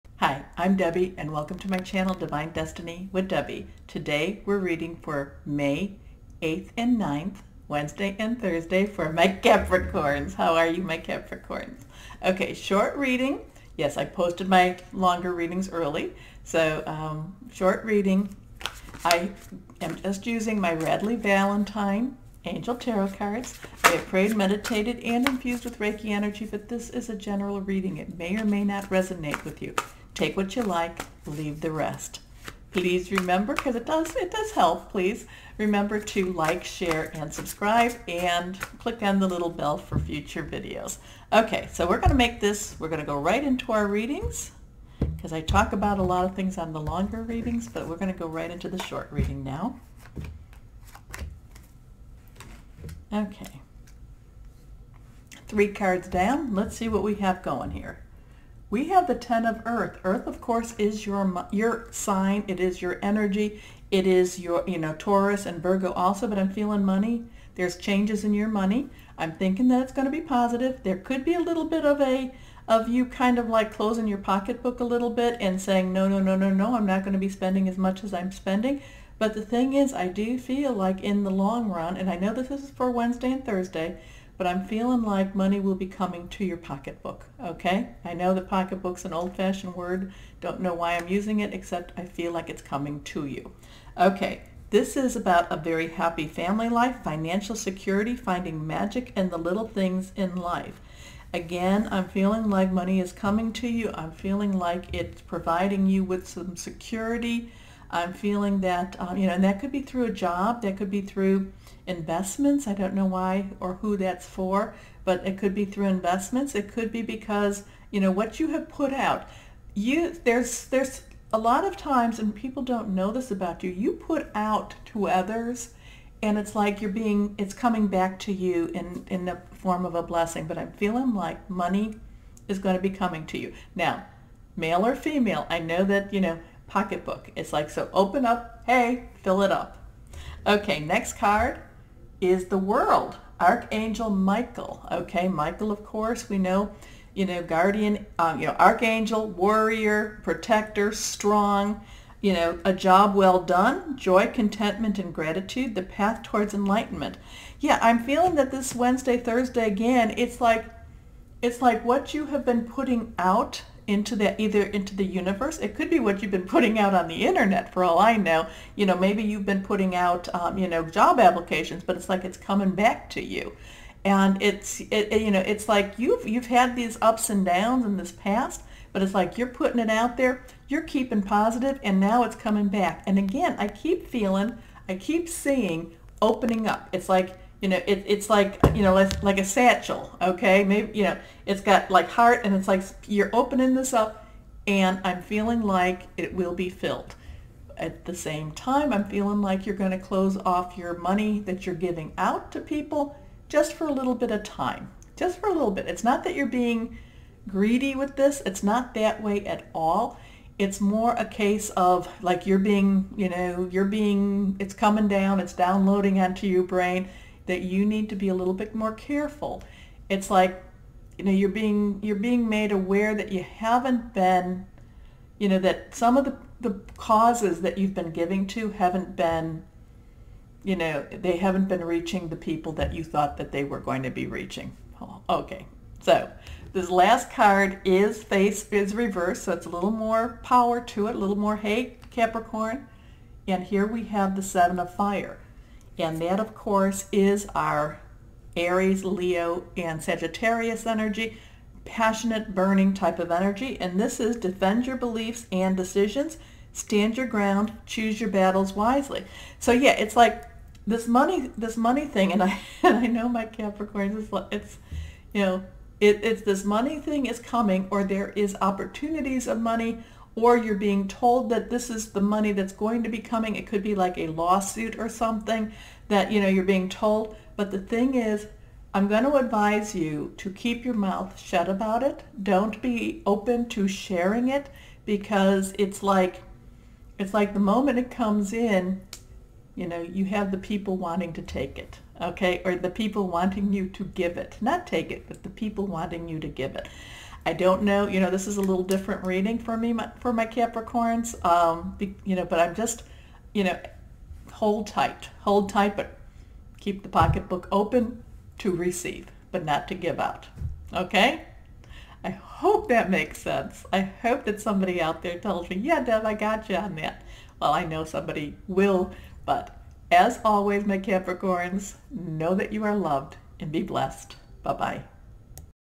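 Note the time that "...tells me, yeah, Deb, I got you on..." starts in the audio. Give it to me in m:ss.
5:15.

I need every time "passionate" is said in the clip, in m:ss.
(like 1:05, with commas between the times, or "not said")
4:11.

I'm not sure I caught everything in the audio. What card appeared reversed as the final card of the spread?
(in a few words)
Seven of Fire.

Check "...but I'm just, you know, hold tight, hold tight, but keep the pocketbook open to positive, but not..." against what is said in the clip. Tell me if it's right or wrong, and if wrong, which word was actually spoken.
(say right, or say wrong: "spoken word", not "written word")
wrong: "receive", not "positive".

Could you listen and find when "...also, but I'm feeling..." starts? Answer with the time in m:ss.
1:05.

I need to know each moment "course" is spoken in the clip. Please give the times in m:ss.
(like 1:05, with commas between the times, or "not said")
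1:00, 2:25, 4:06.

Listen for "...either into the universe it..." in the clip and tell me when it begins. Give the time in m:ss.
2:44.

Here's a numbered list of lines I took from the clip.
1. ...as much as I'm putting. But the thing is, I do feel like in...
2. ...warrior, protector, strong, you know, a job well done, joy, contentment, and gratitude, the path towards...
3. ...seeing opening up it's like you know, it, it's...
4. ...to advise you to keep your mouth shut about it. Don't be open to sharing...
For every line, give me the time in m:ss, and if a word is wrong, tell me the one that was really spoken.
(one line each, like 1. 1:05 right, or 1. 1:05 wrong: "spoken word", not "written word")
1. 1:17 wrong: "spending", not "putting"
2. 2:29 right
3. 3:05 right
4. 4:39 right.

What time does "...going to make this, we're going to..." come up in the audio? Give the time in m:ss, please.
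0:41.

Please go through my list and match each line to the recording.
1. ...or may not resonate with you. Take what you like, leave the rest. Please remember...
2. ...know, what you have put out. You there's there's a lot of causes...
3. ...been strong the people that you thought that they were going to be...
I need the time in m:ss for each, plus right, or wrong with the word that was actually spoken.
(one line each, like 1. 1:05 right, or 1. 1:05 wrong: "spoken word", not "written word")
1. 0:28 right
2. 1:57 wrong: "times", not "causes"
3. 3:51 wrong: "reaching", not "strong".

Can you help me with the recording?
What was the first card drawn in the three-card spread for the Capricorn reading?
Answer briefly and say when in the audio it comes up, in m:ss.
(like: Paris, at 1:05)
10 of Earth, at 0:59.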